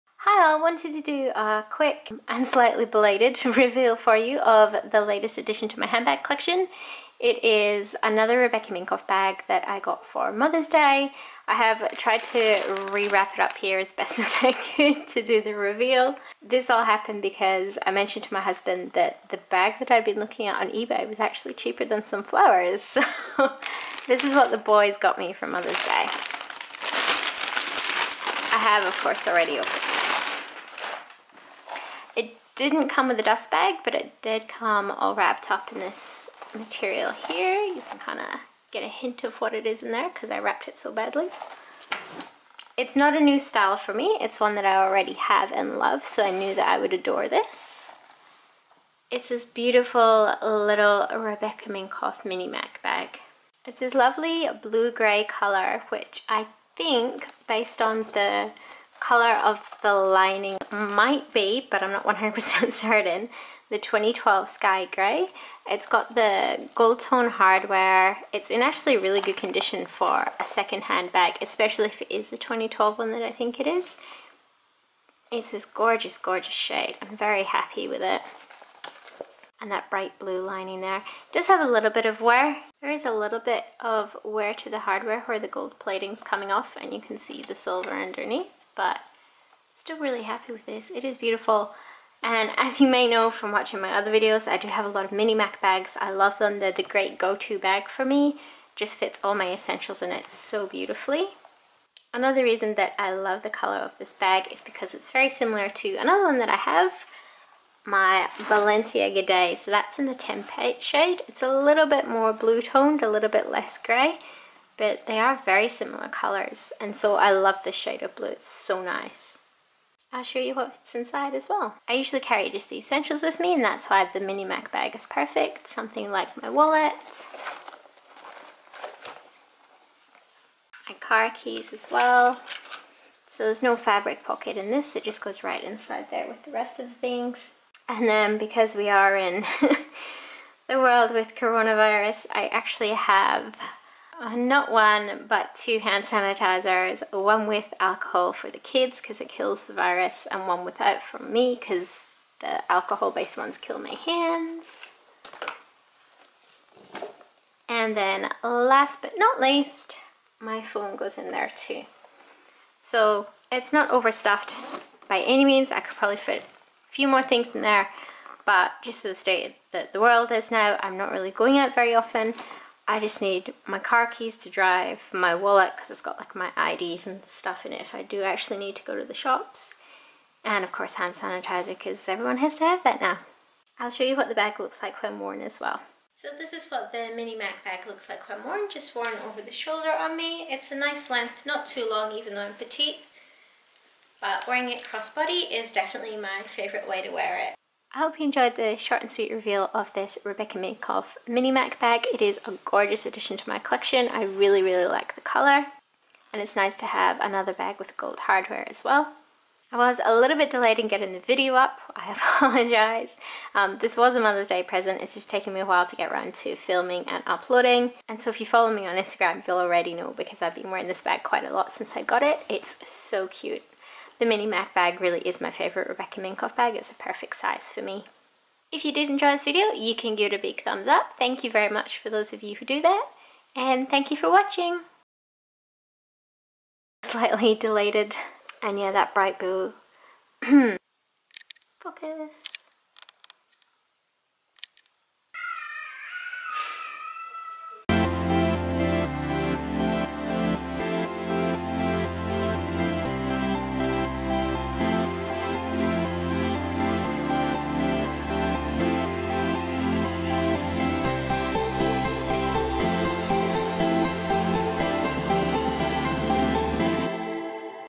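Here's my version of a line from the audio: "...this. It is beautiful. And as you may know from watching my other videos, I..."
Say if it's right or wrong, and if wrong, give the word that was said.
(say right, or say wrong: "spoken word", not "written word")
right.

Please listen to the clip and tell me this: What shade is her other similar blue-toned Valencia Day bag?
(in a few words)
Tempe.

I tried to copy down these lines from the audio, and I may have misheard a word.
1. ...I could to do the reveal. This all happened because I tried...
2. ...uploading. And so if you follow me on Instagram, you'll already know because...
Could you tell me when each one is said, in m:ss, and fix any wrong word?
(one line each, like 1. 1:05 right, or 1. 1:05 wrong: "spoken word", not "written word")
1. 0:14 wrong: "mentioned", not "tried"
2. 3:37 right.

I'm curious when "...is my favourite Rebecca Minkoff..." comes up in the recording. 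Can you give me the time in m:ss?
3:45.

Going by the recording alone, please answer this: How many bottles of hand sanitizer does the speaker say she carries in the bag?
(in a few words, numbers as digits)
2.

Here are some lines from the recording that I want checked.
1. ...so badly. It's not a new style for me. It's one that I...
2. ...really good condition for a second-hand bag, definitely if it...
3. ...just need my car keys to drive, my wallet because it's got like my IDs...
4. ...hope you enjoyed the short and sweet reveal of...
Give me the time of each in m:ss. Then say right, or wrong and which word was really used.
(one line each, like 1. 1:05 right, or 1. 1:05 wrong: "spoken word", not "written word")
1. 0:40 right
2. 1:08 wrong: "especially", not "definitely"
3. 2:52 right
4. 3:17 right.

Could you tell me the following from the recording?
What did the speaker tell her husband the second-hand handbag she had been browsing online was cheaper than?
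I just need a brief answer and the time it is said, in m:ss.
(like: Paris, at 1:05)
Some flowers, at 0:22.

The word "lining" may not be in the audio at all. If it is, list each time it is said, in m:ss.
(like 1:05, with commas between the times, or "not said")
0:59, 1:20.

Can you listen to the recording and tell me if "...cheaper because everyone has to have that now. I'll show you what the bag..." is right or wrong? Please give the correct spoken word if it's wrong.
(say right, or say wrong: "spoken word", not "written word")
wrong: "sanitizer", not "cheaper".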